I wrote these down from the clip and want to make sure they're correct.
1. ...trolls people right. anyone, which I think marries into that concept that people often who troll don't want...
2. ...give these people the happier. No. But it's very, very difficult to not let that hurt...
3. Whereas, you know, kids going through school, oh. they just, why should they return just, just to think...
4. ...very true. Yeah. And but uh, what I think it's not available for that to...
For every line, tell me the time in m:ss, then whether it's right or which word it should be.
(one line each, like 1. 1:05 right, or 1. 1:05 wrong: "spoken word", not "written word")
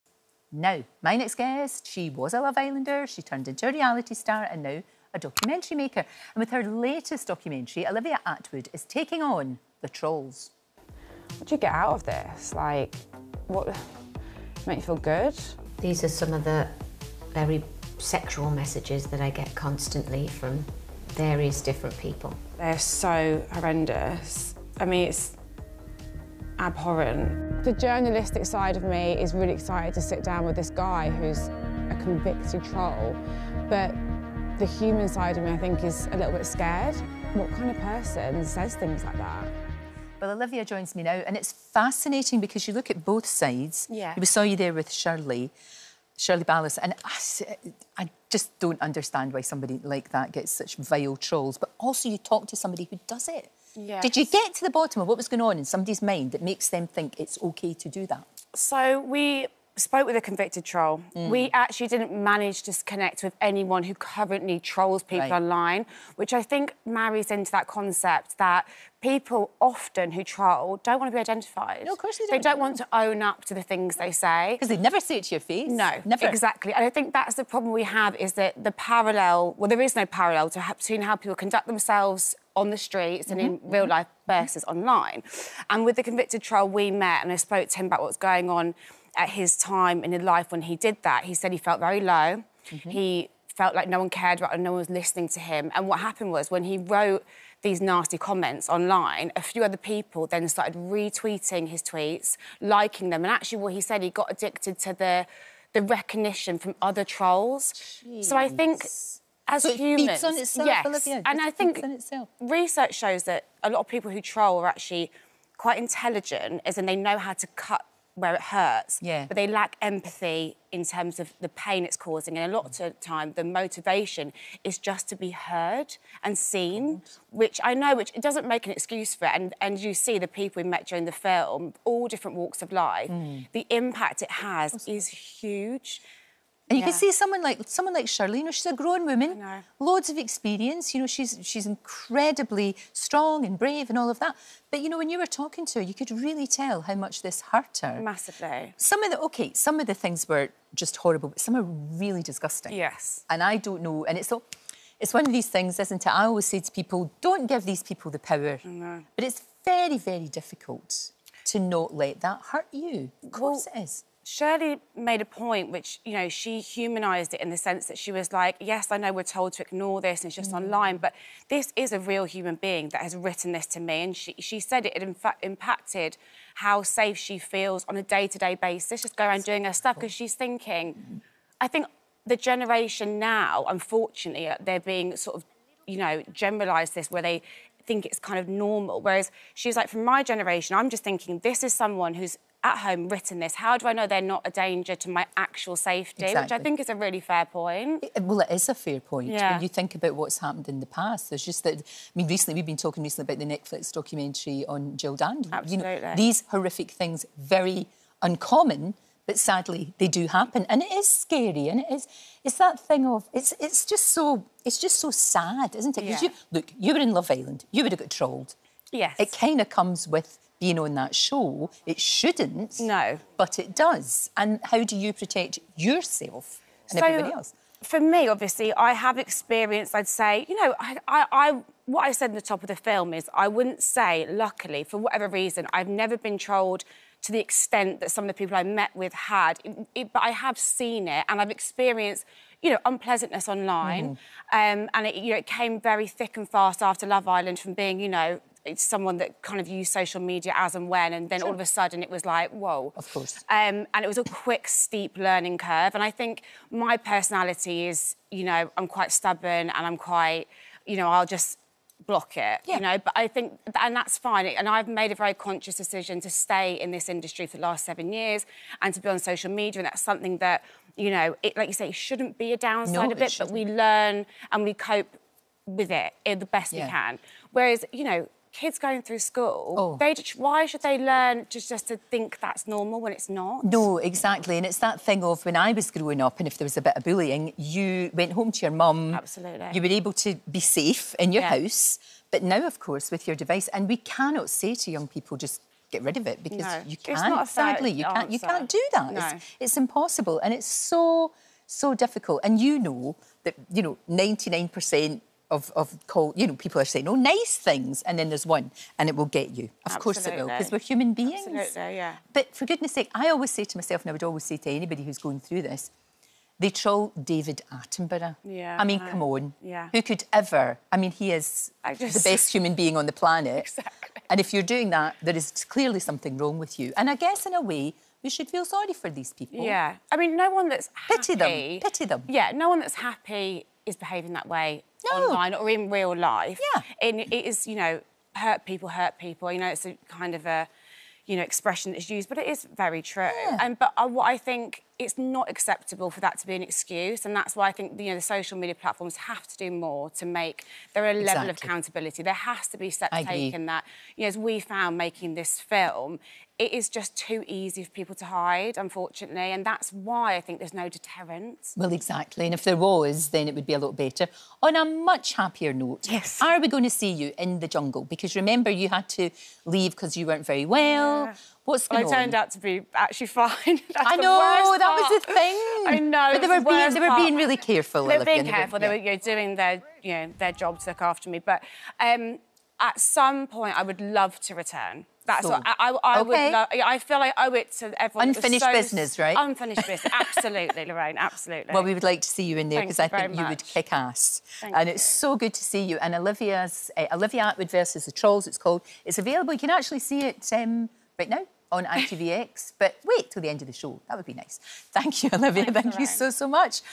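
1. 1:04 wrong: "online", not "anyone"
2. 2:37 wrong: "power", not "happier"
3. 4:37 wrong: "learn", not "return"
4. 5:42 wrong: "acceptable", not "available".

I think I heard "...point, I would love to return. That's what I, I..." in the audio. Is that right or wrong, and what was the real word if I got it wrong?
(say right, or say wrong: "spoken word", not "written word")
right.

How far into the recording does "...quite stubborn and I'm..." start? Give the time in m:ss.
4:18.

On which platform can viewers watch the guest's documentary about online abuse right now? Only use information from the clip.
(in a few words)
ITVX.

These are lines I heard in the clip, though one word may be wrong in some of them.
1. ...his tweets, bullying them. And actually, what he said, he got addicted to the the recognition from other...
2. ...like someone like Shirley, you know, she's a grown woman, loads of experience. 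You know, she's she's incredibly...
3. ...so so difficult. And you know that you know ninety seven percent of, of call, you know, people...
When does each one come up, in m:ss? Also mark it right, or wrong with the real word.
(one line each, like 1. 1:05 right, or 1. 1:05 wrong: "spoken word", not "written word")
1. 1:41 wrong: "liking", not "bullying"
2. 2:17 right
3. 5:00 wrong: "nine", not "seven".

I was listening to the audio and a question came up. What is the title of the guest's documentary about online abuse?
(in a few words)
Olivia Attwood versus the Trolls.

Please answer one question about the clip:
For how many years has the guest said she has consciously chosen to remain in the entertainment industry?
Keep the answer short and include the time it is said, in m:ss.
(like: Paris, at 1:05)
7, at 4:27.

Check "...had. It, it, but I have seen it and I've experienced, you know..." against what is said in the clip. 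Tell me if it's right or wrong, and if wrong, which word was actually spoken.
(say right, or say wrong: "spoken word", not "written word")
right.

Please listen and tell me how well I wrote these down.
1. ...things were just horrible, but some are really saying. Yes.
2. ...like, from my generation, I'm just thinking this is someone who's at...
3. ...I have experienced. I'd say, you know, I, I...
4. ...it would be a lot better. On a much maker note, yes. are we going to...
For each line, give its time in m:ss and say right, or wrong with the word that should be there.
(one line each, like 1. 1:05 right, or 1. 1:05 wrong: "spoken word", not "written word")
1. 2:29 wrong: "disgusting", not "saying"
2. 3:09 right
3. 3:48 right
4. 6:03 wrong: "happier", not "maker".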